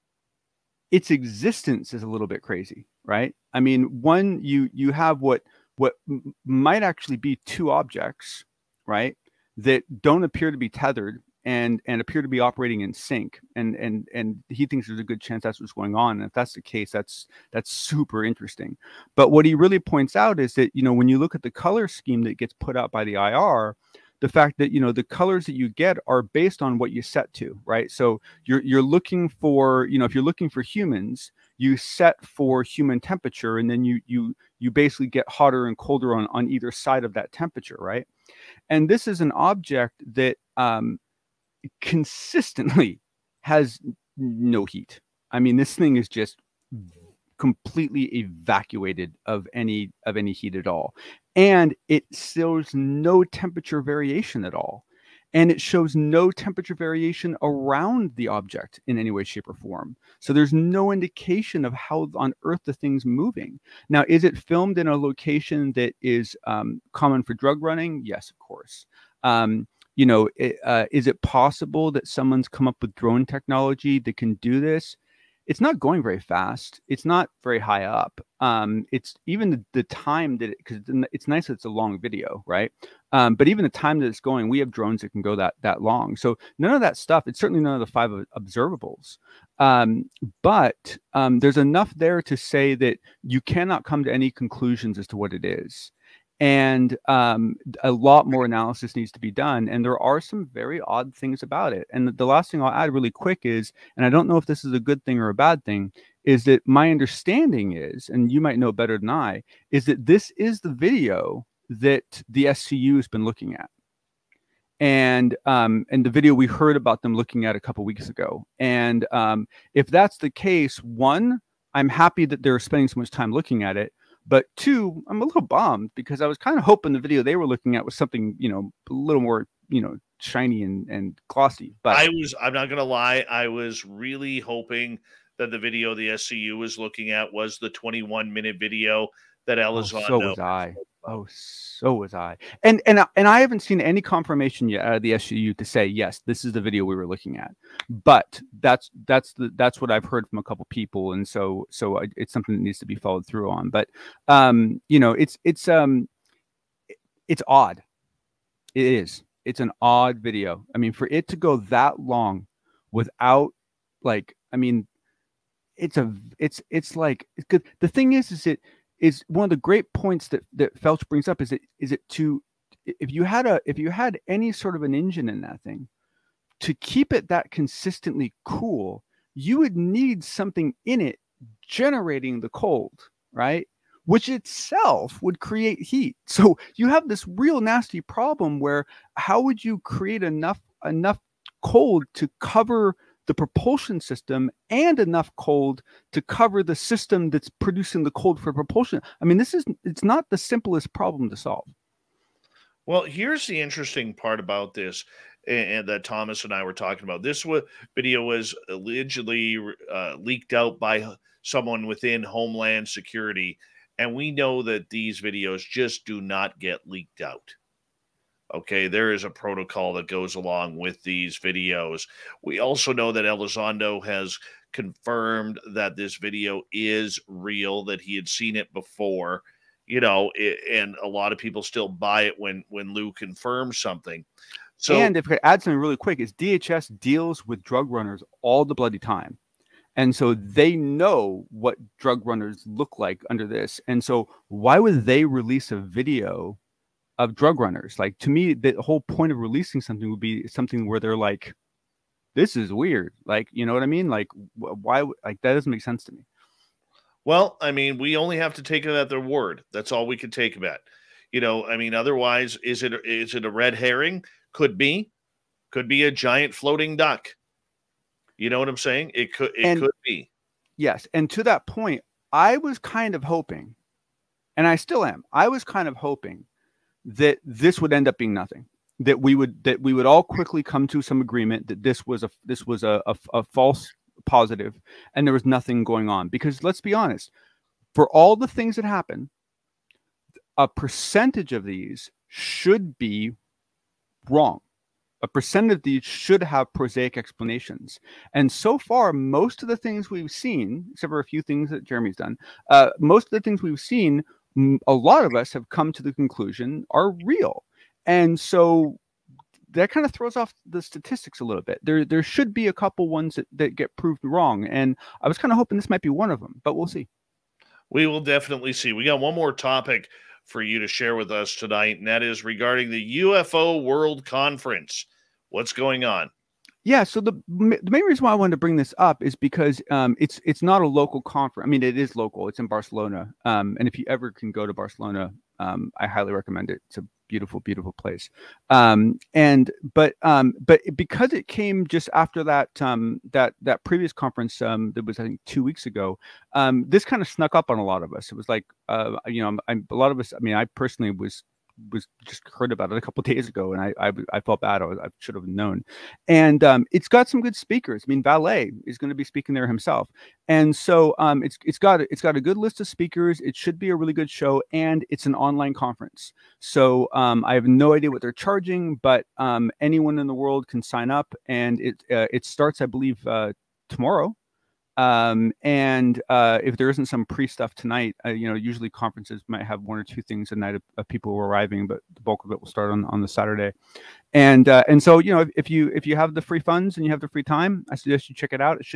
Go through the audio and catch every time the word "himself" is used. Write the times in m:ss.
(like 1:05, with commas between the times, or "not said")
5:59.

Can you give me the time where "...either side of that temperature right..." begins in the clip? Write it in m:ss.
0:36.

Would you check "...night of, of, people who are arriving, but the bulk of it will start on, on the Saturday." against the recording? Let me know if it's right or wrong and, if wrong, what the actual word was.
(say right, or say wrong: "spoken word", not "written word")
right.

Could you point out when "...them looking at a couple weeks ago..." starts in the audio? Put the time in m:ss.
1:57.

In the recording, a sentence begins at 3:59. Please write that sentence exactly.
And so they know what drug runners look like under this.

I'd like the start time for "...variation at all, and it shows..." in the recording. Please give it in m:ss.
0:53.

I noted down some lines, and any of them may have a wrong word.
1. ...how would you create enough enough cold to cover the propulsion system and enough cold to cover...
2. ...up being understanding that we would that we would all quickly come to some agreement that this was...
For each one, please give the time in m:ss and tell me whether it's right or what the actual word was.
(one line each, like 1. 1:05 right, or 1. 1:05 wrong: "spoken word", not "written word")
1. 3:09 right
2. 4:38 wrong: "nothing", not "understanding".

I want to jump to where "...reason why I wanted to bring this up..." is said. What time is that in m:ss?
5:28.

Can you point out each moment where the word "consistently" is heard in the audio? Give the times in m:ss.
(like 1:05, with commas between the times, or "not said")
0:41, 2:57.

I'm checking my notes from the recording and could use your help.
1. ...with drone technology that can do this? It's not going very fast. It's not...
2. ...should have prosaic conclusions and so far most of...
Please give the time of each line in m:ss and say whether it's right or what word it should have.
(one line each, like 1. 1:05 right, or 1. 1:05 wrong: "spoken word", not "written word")
1. 1:12 right
2. 4:56 wrong: "explanations", not "conclusions".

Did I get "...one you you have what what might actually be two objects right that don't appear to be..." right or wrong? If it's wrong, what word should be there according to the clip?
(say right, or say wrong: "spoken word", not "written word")
right.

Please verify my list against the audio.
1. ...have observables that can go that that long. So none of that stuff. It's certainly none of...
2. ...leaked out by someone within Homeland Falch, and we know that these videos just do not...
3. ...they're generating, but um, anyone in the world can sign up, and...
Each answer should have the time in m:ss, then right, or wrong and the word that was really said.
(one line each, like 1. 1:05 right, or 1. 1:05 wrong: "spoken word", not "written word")
1. 1:24 wrong: "drones", not "observables"
2. 3:30 wrong: "Security", not "Falch"
3. 6:08 wrong: "charging", not "generating".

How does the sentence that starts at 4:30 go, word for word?
Yes, and to that point, I was kind of hoping, and I still am.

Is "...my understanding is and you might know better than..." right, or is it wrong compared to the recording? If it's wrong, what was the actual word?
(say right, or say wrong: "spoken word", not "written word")
right.